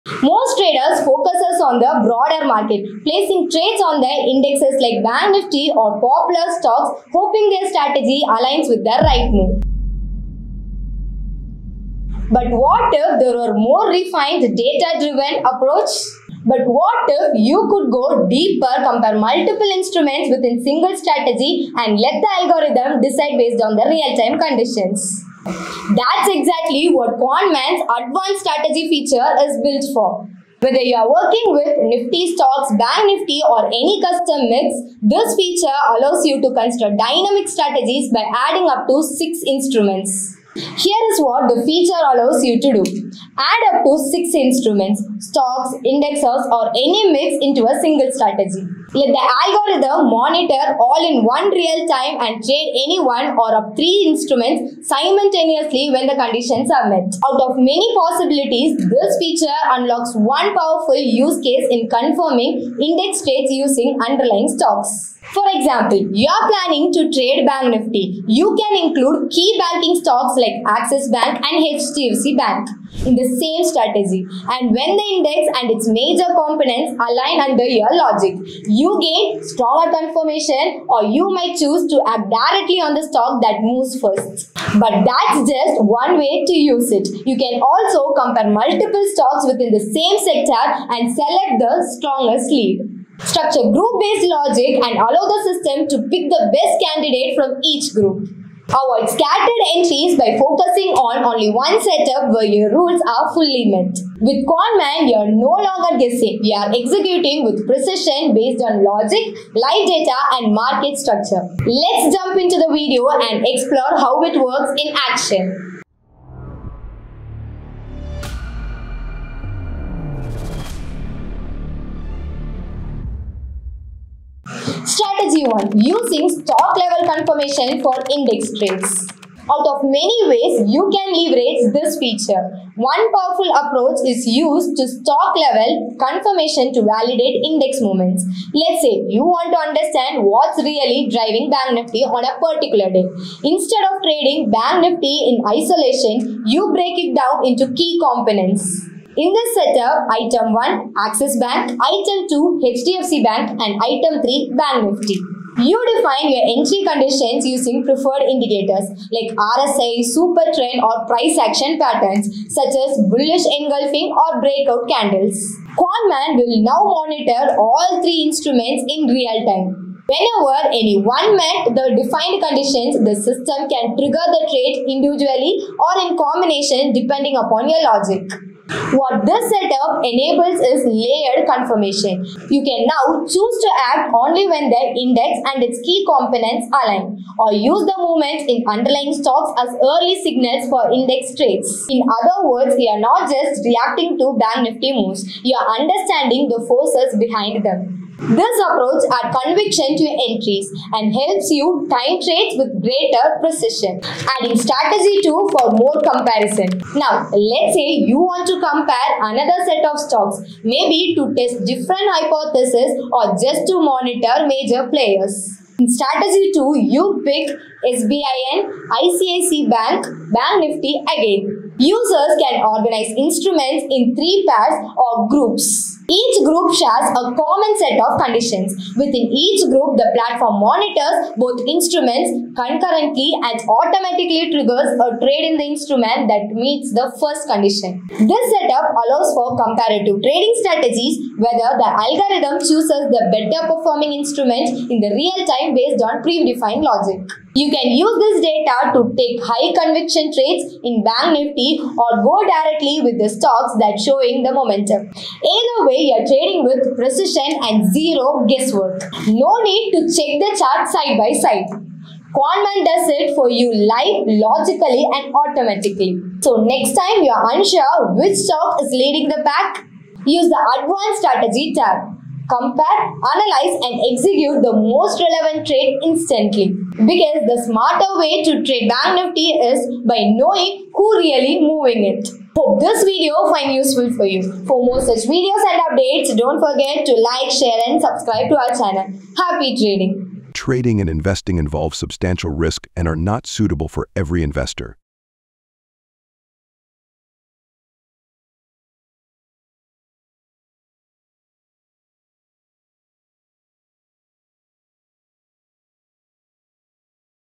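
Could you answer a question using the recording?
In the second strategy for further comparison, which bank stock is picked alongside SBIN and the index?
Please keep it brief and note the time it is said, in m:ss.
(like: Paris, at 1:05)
ICICI Bank, at 3:39.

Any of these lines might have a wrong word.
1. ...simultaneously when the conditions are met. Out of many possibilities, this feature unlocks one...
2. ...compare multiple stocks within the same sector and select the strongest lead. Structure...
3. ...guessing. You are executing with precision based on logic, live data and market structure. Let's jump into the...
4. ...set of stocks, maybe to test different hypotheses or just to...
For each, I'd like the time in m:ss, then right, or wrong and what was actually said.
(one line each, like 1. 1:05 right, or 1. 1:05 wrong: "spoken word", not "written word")
1. 0:54 right
2. 1:28 right
3. 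1:46 right
4. 3:29 right.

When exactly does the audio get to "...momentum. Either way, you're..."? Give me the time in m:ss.
4:14.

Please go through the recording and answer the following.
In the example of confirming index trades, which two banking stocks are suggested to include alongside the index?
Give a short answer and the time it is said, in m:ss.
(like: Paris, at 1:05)
Axis Bank and HDFC Bank, at 1:10.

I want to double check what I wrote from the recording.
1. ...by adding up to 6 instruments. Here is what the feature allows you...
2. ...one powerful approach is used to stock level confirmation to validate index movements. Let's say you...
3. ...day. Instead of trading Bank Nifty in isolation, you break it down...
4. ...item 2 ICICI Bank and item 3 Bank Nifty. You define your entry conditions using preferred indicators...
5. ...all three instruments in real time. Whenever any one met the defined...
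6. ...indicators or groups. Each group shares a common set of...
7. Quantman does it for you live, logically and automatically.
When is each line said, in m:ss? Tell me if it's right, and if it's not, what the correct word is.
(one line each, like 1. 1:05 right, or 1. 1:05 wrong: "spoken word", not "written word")
1. 0:38 right
2. 2:12 right
3. 2:22 right
4. 2:31 wrong: "HDFC", not "ICICI"
5. 2:47 right
6. 3:44 wrong: "pairs", not "indicators"
7. 4:22 right.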